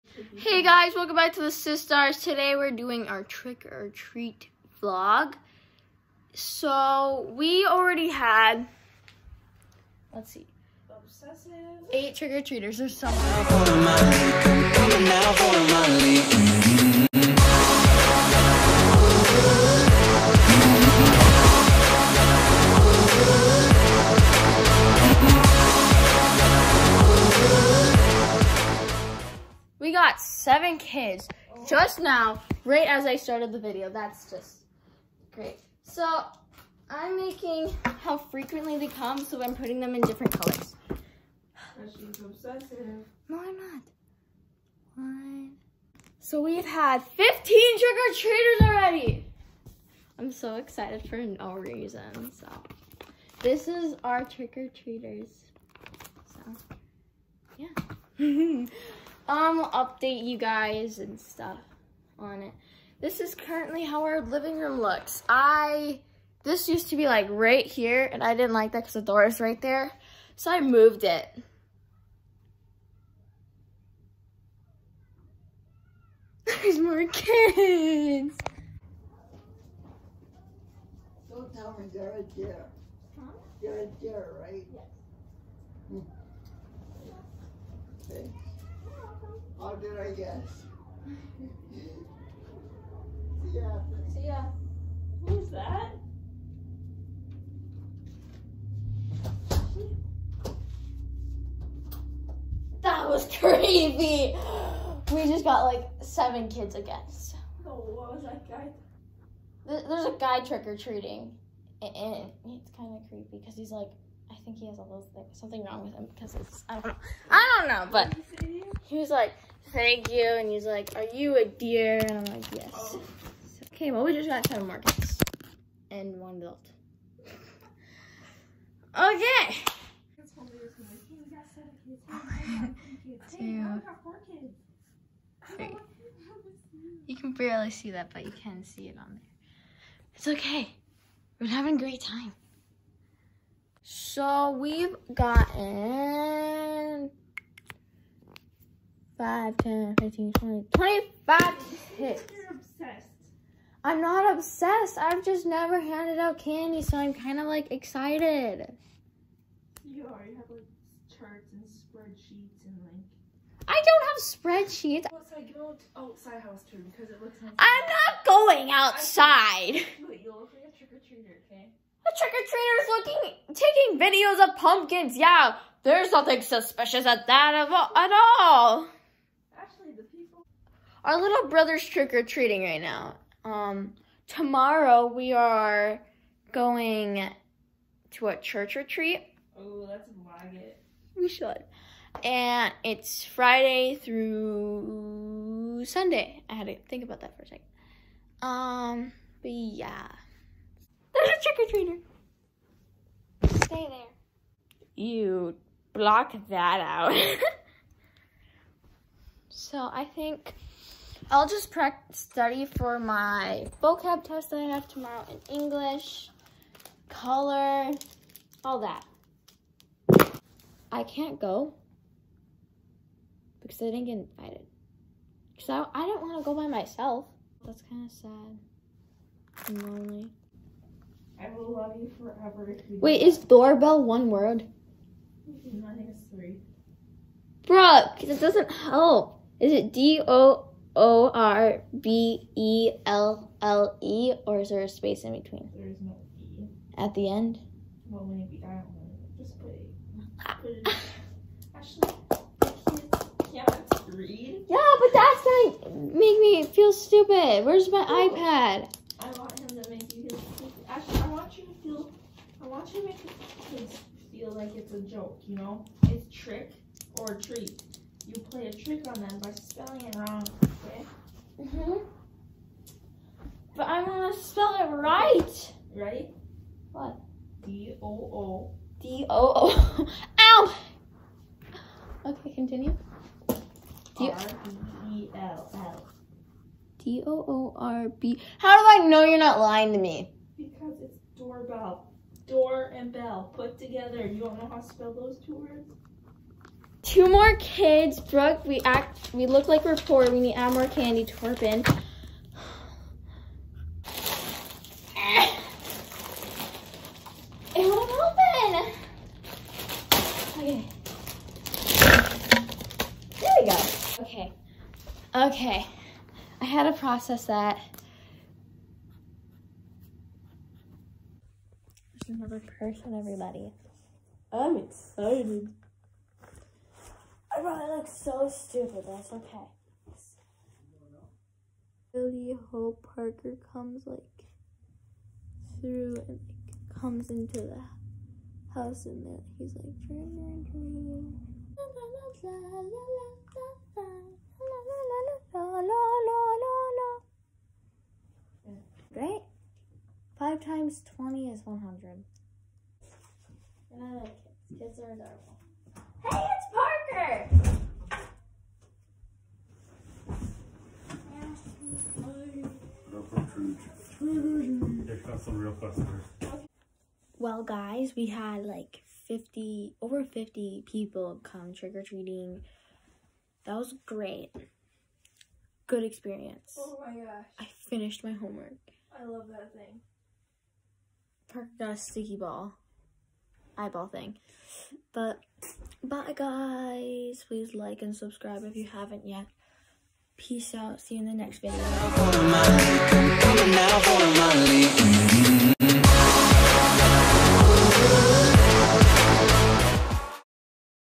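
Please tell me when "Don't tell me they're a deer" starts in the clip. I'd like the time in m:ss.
1:21.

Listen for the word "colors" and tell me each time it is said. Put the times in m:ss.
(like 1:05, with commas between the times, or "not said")
0:40, 3:37.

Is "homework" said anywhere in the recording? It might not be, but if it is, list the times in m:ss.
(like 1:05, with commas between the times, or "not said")
6:18.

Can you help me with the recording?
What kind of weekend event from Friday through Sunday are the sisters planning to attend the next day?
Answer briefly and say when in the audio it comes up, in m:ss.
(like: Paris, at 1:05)
Church retreat, at 3:08.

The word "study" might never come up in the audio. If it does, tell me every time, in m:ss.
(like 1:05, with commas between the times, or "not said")
3:32.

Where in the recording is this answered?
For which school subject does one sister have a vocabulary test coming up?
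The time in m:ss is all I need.
3:35.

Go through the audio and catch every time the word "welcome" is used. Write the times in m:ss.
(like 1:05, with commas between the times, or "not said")
0:00.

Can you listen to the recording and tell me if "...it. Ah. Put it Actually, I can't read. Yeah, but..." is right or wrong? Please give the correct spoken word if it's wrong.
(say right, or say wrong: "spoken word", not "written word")
right.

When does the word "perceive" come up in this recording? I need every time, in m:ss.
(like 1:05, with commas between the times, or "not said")
not said.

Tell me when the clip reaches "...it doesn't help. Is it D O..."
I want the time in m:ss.
3:58.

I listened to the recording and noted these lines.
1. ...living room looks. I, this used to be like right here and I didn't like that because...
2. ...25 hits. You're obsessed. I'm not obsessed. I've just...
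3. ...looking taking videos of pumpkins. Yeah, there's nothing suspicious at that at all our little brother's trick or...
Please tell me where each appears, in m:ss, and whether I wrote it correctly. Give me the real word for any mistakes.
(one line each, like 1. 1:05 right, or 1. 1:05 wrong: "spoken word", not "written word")
1. 1:04 right
2. 2:30 right
3. 2:52 right.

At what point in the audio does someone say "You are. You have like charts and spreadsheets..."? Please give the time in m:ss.
2:39.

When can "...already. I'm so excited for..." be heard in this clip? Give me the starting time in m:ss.
0:48.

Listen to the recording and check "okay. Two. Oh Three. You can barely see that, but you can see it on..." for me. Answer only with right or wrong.
right.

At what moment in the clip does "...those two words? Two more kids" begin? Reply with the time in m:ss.
4:55.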